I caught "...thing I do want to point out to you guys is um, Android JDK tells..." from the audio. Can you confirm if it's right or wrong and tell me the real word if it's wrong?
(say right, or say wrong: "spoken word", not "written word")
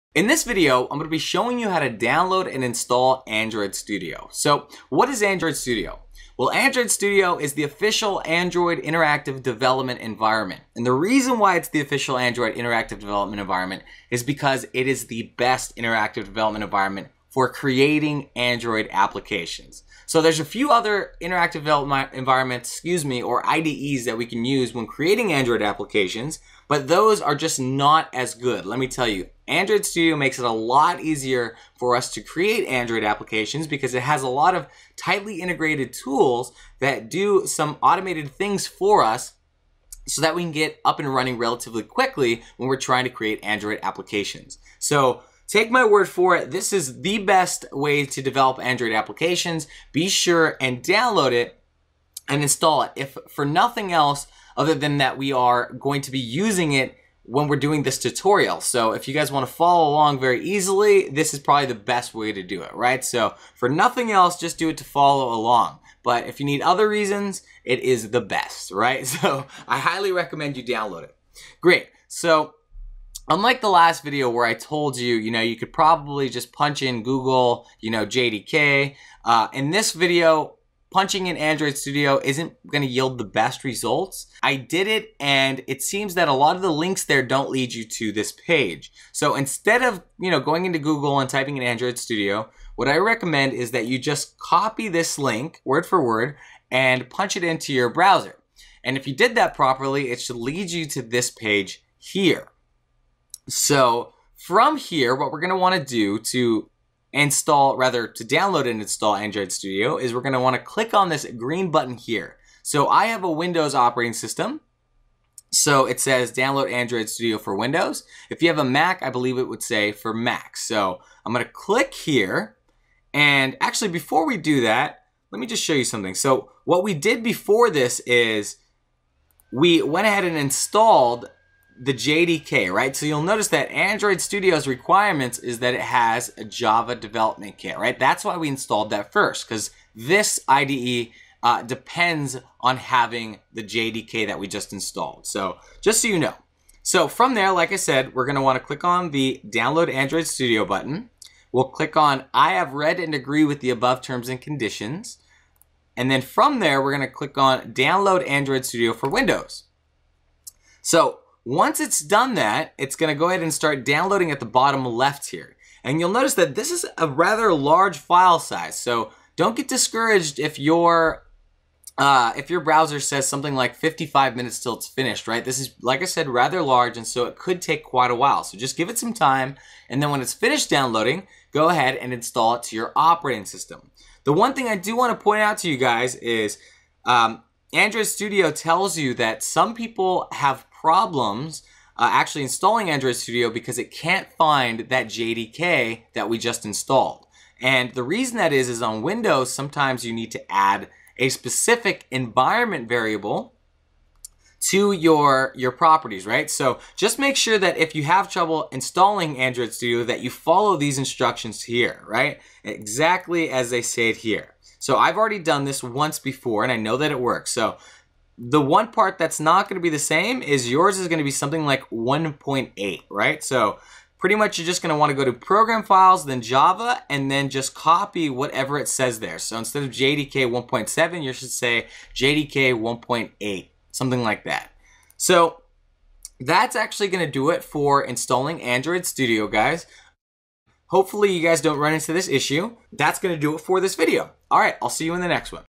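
wrong: "Studio", not "JDK".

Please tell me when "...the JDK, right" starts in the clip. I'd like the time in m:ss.
2:11.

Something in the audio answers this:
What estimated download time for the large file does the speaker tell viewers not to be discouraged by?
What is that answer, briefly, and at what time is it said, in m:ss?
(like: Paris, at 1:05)
55 minutes, at 2:53.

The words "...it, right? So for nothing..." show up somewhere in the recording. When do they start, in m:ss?
1:02.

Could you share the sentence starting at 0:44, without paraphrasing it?
So Take my word for it, this is the best way to develop Android applications.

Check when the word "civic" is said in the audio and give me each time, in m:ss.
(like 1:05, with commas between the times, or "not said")
not said.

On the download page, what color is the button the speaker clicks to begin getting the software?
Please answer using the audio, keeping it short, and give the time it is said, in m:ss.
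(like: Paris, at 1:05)
Green, at 1:51.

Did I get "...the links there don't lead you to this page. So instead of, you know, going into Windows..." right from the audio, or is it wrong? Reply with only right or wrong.
wrong.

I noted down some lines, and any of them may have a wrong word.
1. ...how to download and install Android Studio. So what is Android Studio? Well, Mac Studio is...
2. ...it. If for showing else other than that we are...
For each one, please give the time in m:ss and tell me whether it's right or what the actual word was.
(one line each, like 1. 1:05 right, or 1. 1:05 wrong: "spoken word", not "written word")
1. 0:01 wrong: "Android", not "Mac"
2. 0:52 wrong: "nothing", not "showing".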